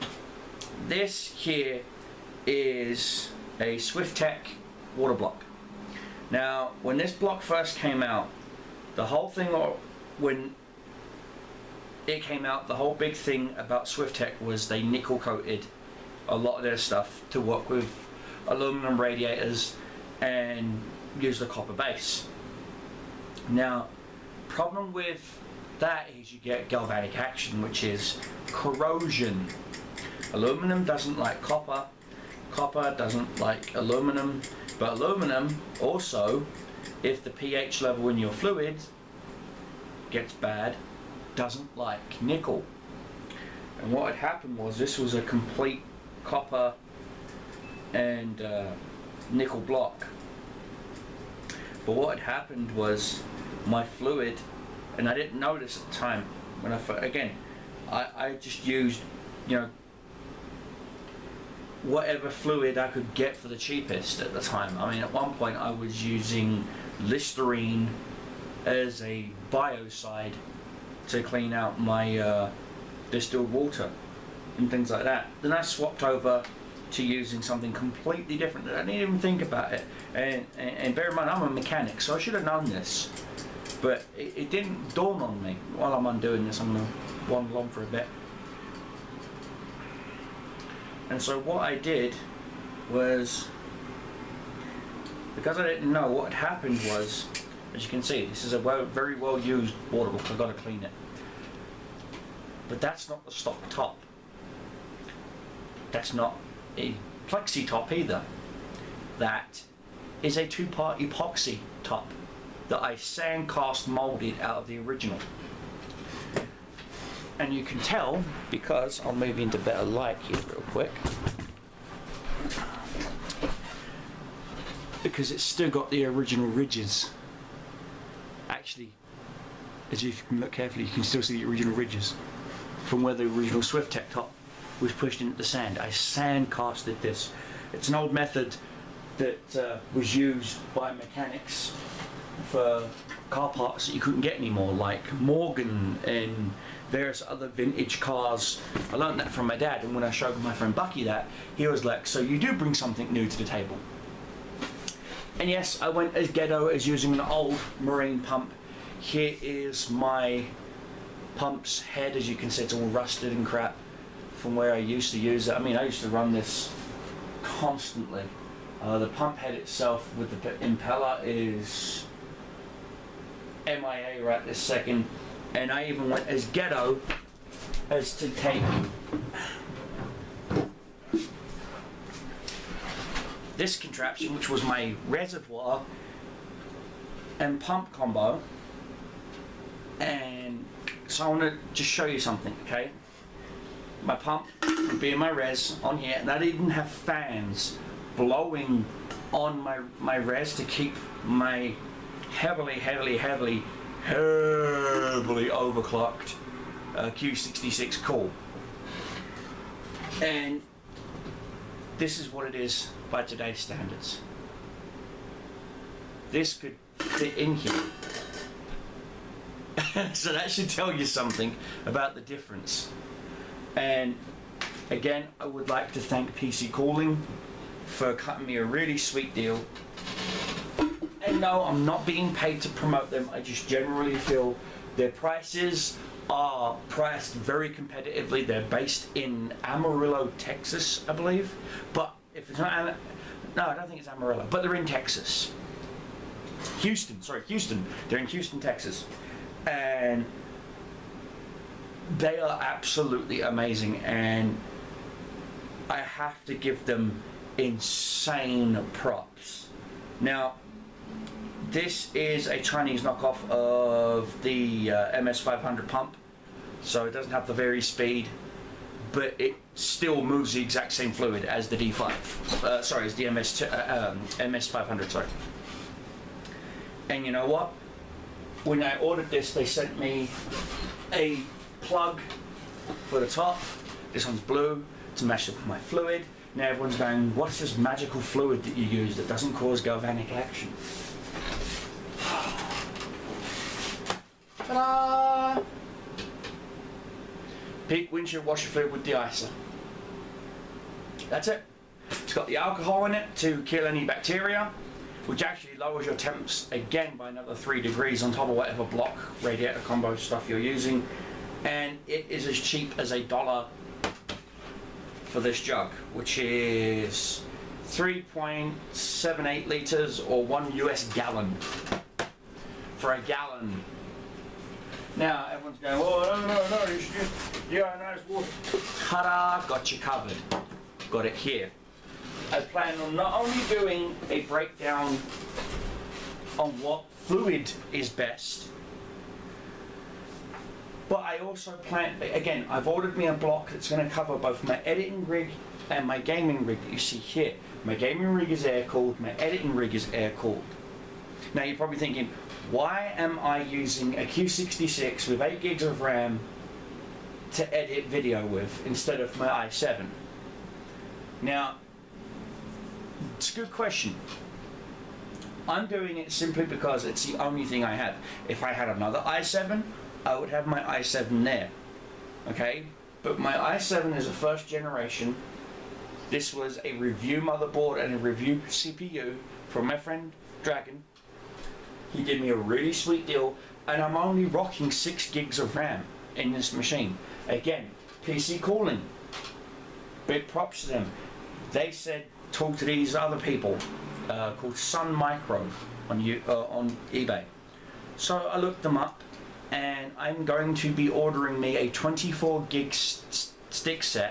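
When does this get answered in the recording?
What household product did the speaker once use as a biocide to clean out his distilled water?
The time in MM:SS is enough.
01:07.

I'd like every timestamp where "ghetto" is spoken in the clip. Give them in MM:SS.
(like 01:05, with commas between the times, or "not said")
02:36, 02:56.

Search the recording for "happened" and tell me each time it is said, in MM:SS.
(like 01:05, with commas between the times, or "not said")
00:44, 00:52, 01:36.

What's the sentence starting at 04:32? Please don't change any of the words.
Uh, sorry, as the MS uh, um, MS500.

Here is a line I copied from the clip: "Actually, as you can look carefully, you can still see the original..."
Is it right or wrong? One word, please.
right.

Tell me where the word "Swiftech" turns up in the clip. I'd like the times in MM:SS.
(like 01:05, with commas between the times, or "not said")
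00:03, 00:13, 02:13.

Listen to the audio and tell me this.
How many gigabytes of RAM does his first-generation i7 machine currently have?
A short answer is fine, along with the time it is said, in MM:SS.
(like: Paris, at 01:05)
6, at 06:24.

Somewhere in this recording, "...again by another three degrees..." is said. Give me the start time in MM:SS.
05:06.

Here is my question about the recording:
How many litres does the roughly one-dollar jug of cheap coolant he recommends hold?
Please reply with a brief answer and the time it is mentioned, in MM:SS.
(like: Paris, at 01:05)
3.78, at 05:17.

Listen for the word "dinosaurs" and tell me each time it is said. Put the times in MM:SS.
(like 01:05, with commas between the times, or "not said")
not said.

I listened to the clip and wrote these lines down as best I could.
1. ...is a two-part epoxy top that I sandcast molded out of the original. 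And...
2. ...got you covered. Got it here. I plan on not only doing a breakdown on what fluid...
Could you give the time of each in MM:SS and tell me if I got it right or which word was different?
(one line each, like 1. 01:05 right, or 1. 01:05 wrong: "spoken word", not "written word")
1. 01:50 right
2. 05:29 right.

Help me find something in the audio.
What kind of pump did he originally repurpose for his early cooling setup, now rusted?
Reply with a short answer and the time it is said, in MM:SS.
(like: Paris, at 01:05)
Marine pump, at 02:37.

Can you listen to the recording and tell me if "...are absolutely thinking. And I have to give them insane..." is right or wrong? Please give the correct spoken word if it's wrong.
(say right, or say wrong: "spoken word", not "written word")
wrong: "amazing", not "thinking".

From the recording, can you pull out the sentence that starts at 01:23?
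But it, it didn't dawn on me while I'm undoing this.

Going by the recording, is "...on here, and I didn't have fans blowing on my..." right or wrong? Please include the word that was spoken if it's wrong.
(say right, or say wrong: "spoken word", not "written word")
right.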